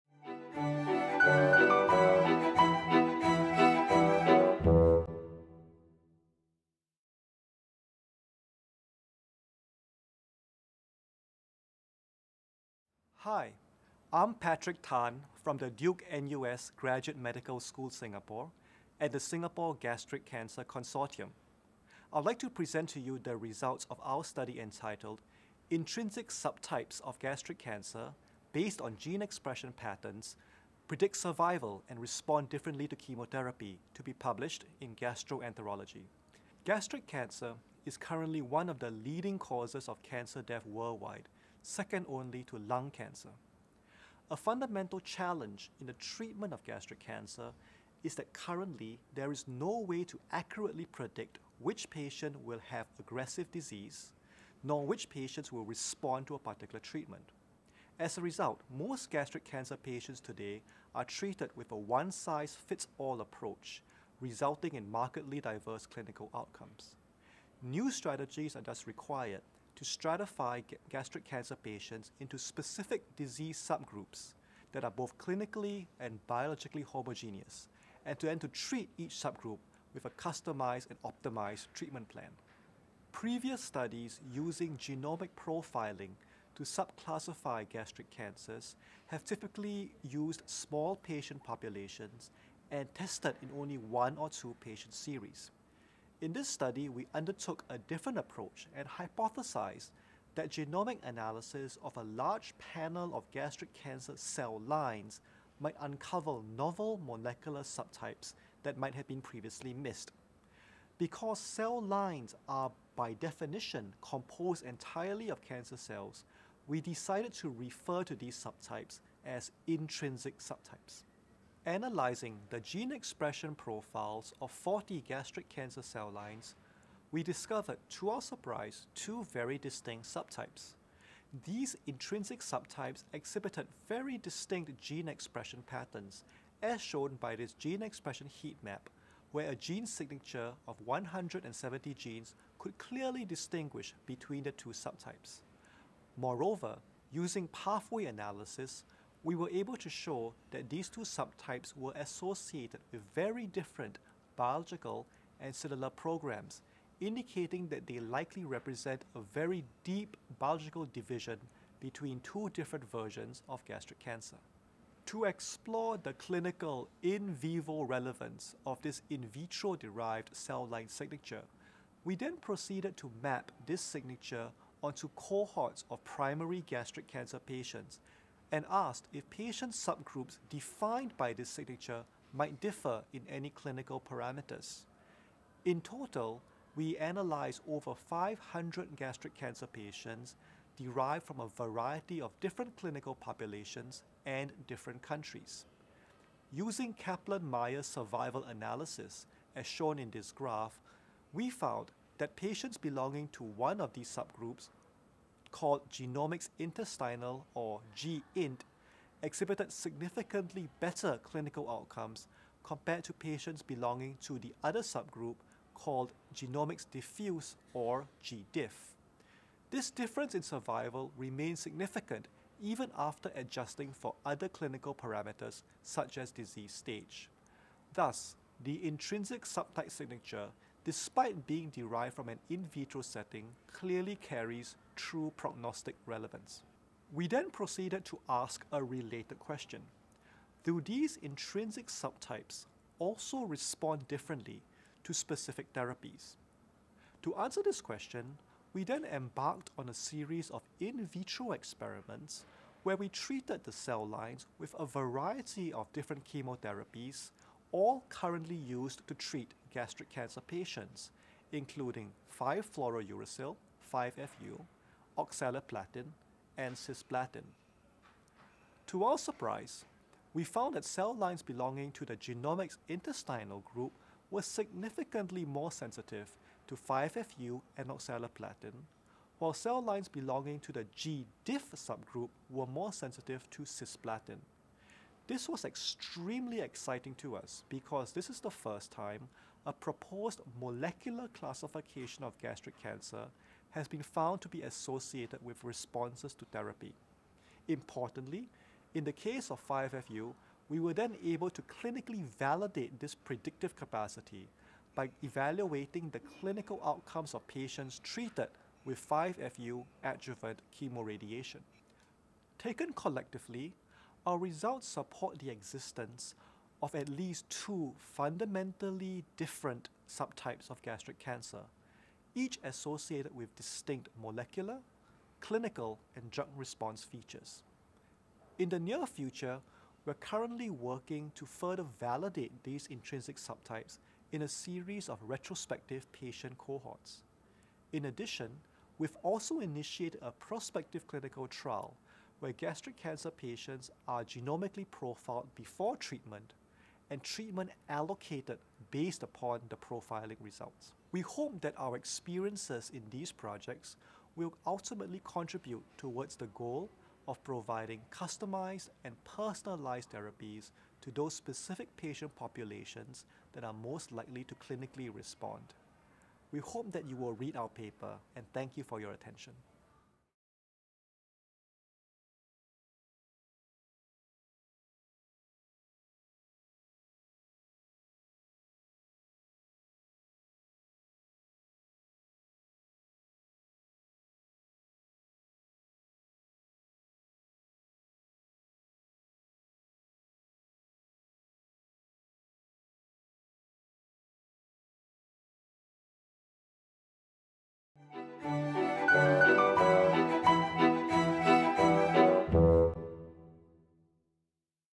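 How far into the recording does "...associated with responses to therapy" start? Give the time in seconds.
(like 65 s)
294 s.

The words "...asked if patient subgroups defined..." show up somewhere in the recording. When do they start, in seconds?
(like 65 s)
178 s.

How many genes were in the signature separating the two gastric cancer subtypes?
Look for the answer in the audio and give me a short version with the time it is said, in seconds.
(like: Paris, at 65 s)
170, at 140 s.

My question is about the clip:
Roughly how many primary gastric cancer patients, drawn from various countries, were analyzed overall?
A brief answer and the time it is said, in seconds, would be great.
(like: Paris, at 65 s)
over 500, at 187 s.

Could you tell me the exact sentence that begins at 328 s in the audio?
In the near future, we're currently working to further validate these intrinsic subtypes in a series of retrospective patient cohorts.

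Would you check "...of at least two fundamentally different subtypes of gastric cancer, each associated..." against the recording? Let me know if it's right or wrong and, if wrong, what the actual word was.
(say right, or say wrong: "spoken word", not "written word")
right.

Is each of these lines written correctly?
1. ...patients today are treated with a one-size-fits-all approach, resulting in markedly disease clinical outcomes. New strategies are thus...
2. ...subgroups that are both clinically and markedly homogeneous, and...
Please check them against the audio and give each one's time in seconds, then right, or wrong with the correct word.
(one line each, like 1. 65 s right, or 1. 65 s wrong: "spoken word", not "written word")
1. 59 s wrong: "diverse", not "disease"
2. 73 s wrong: "biologically", not "markedly".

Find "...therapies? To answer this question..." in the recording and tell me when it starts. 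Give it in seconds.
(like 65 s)
245 s.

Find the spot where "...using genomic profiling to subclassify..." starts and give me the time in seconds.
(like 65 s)
84 s.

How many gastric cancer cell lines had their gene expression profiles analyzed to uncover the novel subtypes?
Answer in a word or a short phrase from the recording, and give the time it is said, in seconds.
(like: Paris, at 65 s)
40, at 124 s.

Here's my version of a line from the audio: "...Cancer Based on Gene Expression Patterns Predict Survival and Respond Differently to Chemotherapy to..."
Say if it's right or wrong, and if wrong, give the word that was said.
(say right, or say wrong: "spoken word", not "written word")
right.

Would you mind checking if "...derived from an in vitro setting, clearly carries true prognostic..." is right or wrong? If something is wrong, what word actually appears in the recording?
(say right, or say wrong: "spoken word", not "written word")
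right.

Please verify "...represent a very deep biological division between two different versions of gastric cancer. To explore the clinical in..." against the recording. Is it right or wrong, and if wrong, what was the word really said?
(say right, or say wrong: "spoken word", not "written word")
right.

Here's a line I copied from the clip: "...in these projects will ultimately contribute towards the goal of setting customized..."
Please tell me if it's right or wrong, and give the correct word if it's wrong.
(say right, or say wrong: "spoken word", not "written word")
wrong: "providing", not "setting".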